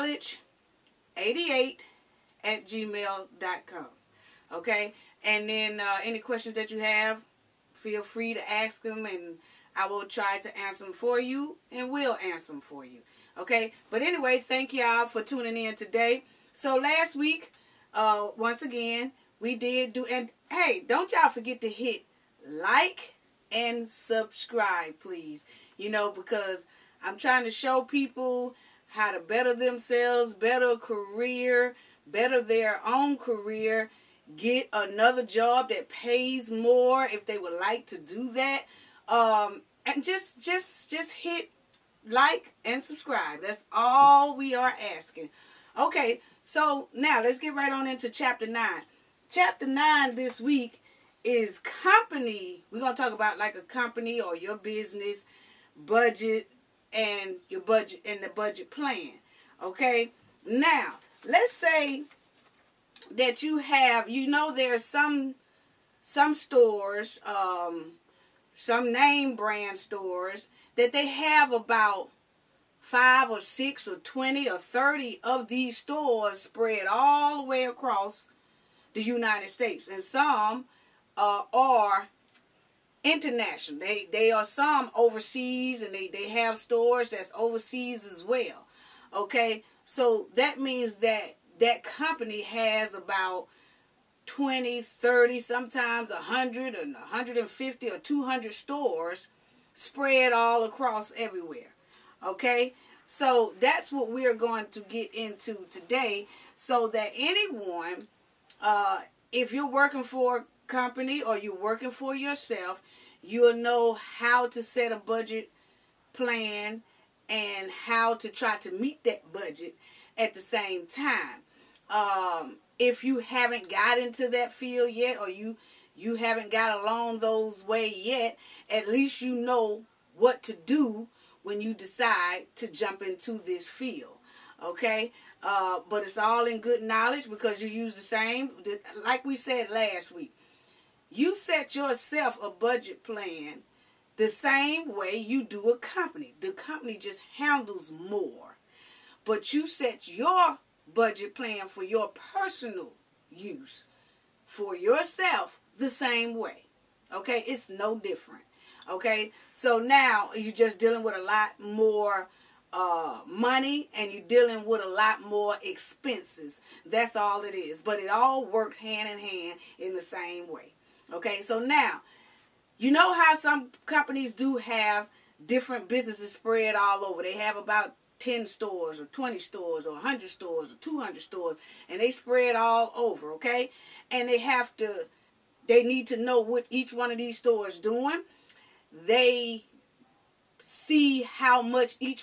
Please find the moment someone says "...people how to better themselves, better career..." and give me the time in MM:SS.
00:27.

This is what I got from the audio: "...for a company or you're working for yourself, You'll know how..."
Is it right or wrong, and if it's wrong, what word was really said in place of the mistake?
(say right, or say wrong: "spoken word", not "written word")
right.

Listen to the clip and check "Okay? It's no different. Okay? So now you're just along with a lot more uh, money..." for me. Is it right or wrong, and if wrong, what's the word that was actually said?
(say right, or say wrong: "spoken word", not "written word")
wrong: "dealing", not "along".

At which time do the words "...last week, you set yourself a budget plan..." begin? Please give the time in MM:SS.
02:19.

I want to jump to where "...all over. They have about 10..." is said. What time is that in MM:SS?
02:56.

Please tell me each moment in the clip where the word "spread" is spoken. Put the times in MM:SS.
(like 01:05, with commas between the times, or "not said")
01:16, 01:39, 02:56, 03:02.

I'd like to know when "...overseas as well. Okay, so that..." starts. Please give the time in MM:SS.
01:27.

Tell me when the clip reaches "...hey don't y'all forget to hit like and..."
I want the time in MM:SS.
00:20.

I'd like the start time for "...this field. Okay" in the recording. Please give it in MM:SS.
02:13.